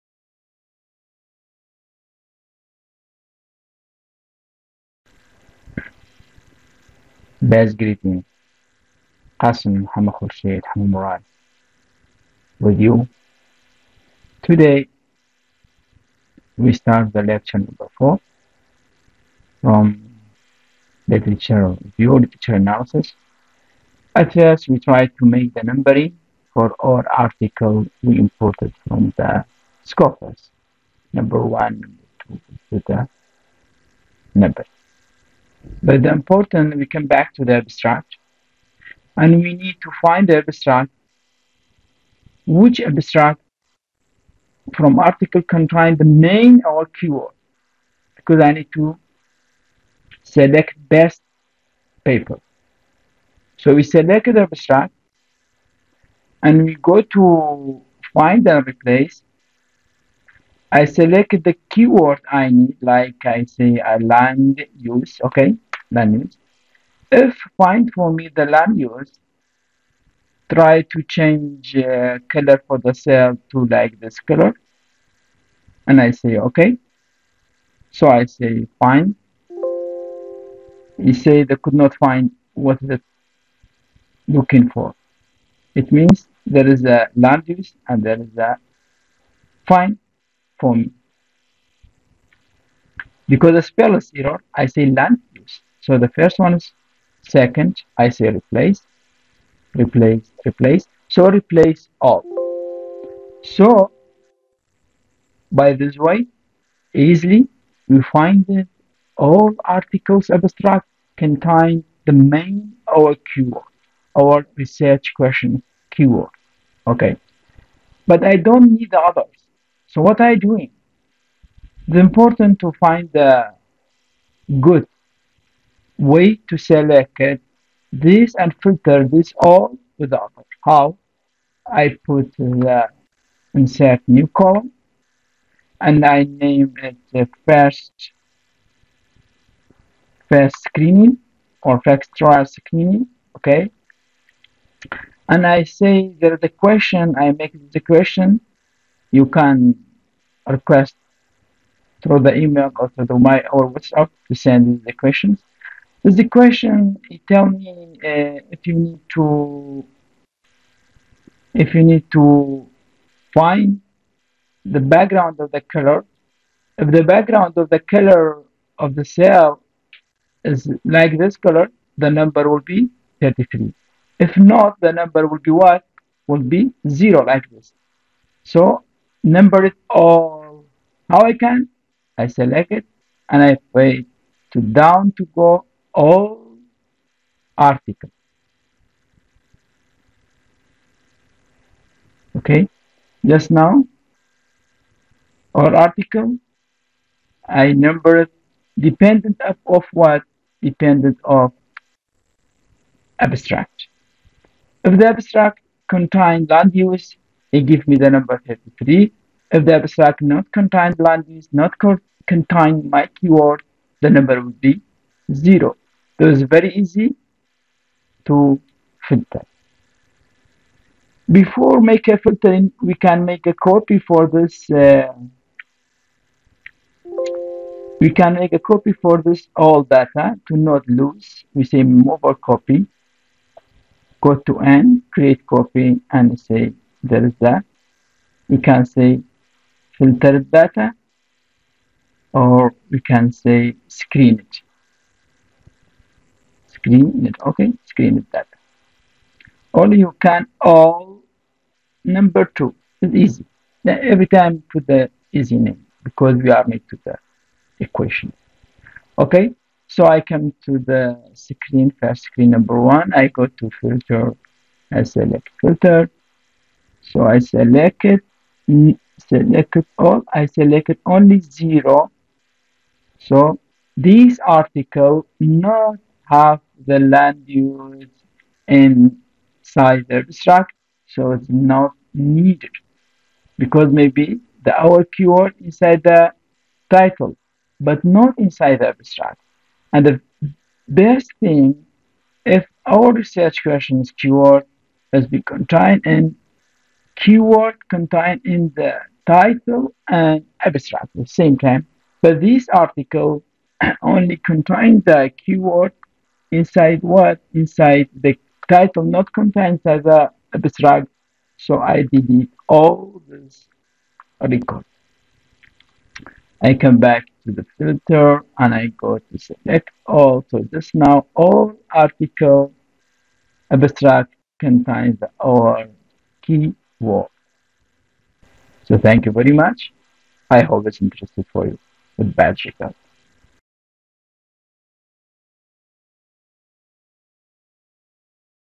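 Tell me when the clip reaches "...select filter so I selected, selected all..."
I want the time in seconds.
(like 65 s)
265 s.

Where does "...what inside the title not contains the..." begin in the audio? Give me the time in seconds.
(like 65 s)
307 s.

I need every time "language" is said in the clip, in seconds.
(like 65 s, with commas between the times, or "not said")
210 s.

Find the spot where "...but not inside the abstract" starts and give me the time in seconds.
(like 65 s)
287 s.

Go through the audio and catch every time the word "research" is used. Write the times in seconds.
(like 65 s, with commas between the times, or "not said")
114 s, 293 s.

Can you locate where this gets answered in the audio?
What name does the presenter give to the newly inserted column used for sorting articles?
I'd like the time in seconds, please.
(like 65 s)
140 s.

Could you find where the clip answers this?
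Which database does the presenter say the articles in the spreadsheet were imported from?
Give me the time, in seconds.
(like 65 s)
29 s.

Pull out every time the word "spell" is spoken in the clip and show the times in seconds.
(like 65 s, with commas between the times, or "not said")
93 s.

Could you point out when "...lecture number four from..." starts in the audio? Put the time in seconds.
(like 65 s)
17 s.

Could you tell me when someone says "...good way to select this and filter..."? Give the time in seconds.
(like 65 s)
124 s.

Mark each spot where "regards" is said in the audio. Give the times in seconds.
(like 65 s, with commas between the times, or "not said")
332 s.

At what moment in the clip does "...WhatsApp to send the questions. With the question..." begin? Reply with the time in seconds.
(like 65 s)
153 s.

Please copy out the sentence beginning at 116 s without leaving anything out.
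Okay, but I don't need the others so what are you doing?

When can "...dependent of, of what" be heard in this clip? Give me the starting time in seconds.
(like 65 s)
198 s.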